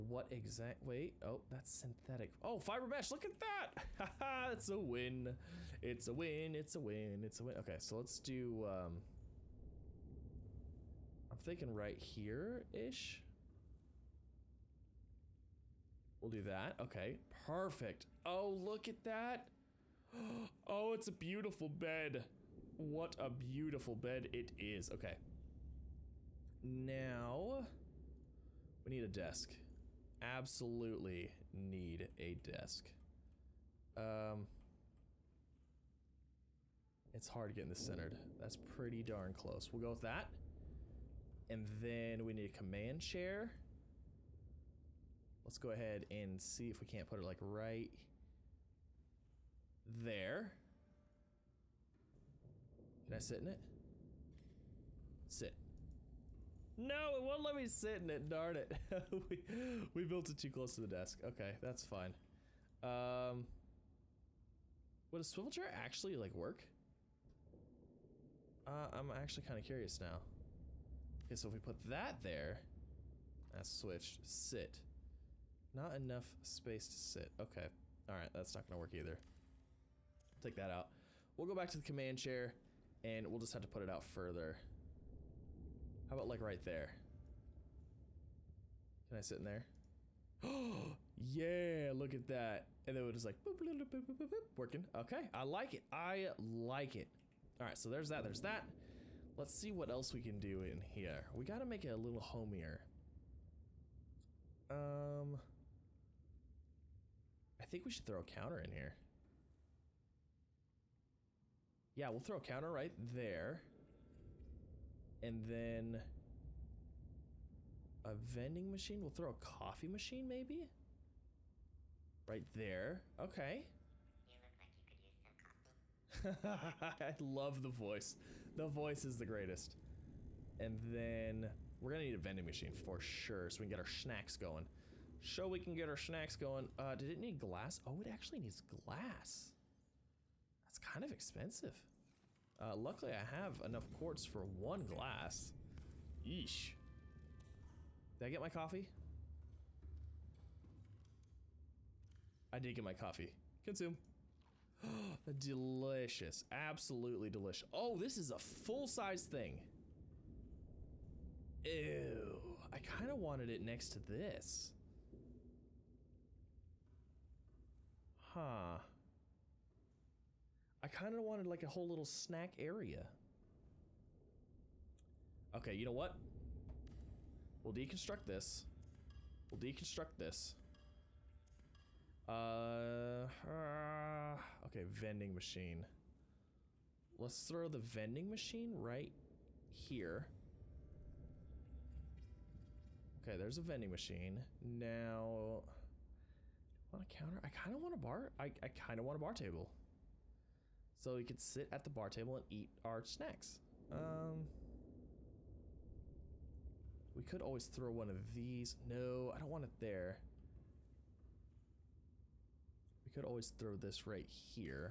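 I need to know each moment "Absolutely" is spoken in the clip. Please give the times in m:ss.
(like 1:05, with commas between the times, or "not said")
0:30, 2:36.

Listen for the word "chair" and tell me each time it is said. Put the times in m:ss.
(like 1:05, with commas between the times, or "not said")
0:43, 1:05, 1:22.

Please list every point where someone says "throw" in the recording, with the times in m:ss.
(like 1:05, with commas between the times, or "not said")
1:48, 1:52, 1:59, 3:07, 3:27, 3:33.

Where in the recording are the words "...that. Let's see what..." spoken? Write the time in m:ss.
1:38.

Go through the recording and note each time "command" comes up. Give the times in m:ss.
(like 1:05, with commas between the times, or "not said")
0:42, 1:21.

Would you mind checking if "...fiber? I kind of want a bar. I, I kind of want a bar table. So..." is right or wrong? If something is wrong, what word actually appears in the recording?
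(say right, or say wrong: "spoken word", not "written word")
wrong: "counter", not "fiber".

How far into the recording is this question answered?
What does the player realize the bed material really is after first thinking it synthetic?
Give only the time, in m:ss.
0:02.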